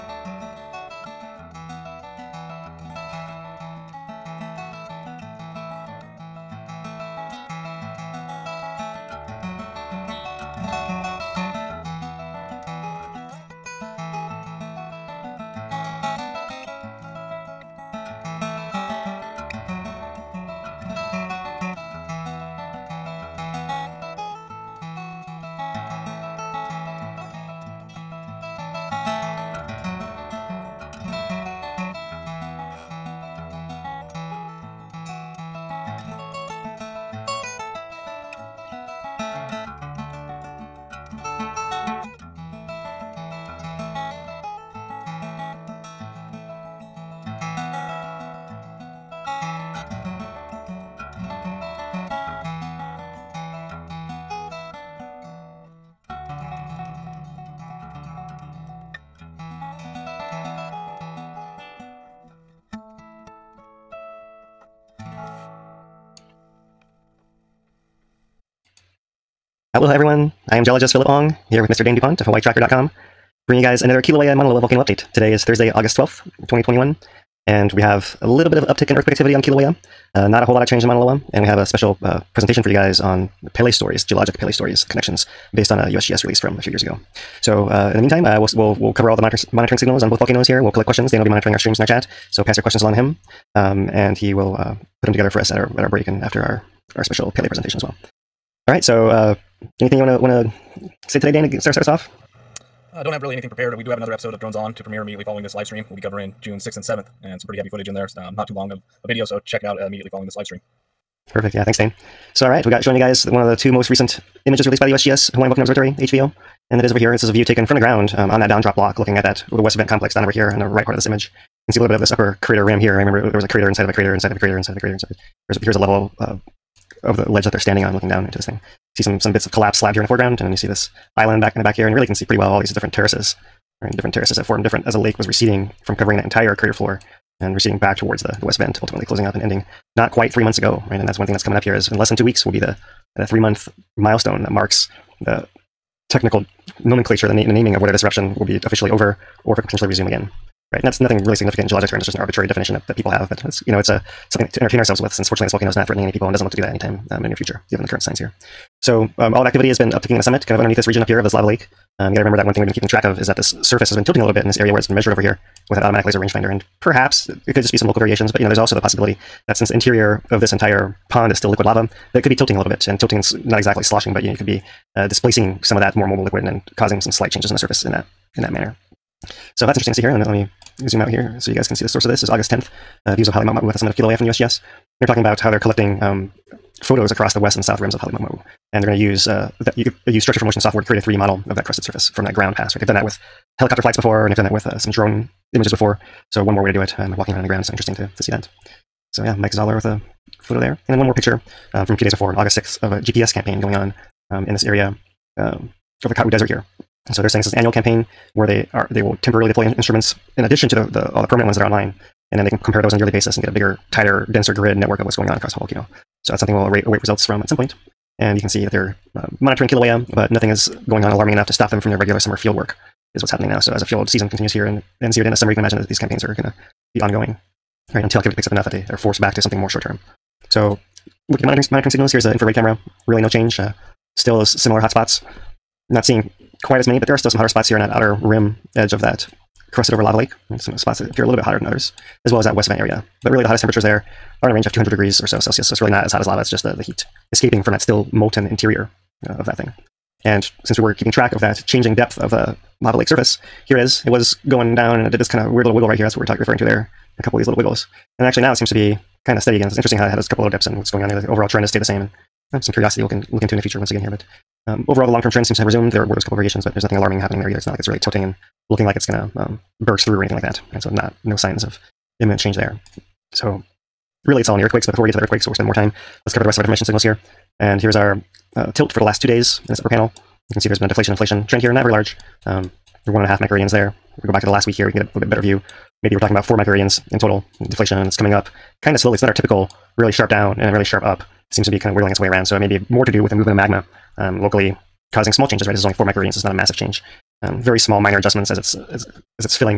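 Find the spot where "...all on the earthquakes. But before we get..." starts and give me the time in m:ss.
4:34.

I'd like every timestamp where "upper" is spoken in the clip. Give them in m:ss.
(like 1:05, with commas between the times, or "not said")
2:02, 4:39.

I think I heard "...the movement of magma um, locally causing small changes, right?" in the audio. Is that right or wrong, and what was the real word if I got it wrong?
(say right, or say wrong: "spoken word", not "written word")
right.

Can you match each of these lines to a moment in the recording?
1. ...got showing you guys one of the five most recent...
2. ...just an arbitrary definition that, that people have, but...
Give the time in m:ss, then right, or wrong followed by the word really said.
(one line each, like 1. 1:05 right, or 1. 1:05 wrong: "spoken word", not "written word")
1. 1:52 wrong: "two", not "five"
2. 2:32 right.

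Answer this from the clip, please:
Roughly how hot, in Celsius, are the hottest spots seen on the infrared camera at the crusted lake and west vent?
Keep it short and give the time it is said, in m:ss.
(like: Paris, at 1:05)
200 degrees, at 4:04.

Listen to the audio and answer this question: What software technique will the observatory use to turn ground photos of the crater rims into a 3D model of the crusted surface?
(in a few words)
structure for motion.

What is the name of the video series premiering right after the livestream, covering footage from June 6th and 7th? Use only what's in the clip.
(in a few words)
Drones On.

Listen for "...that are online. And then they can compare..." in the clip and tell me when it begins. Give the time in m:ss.
3:31.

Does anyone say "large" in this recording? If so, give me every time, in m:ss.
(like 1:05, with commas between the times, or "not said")
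4:41.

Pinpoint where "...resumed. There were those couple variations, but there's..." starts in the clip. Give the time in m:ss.
4:25.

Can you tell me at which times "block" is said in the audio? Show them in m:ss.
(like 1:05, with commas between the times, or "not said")
1:58.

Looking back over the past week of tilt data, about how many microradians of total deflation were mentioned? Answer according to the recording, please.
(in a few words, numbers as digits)
4 microradians.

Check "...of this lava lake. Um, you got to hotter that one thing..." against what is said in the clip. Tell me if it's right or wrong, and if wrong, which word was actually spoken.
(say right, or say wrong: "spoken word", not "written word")
wrong: "remember", not "hotter".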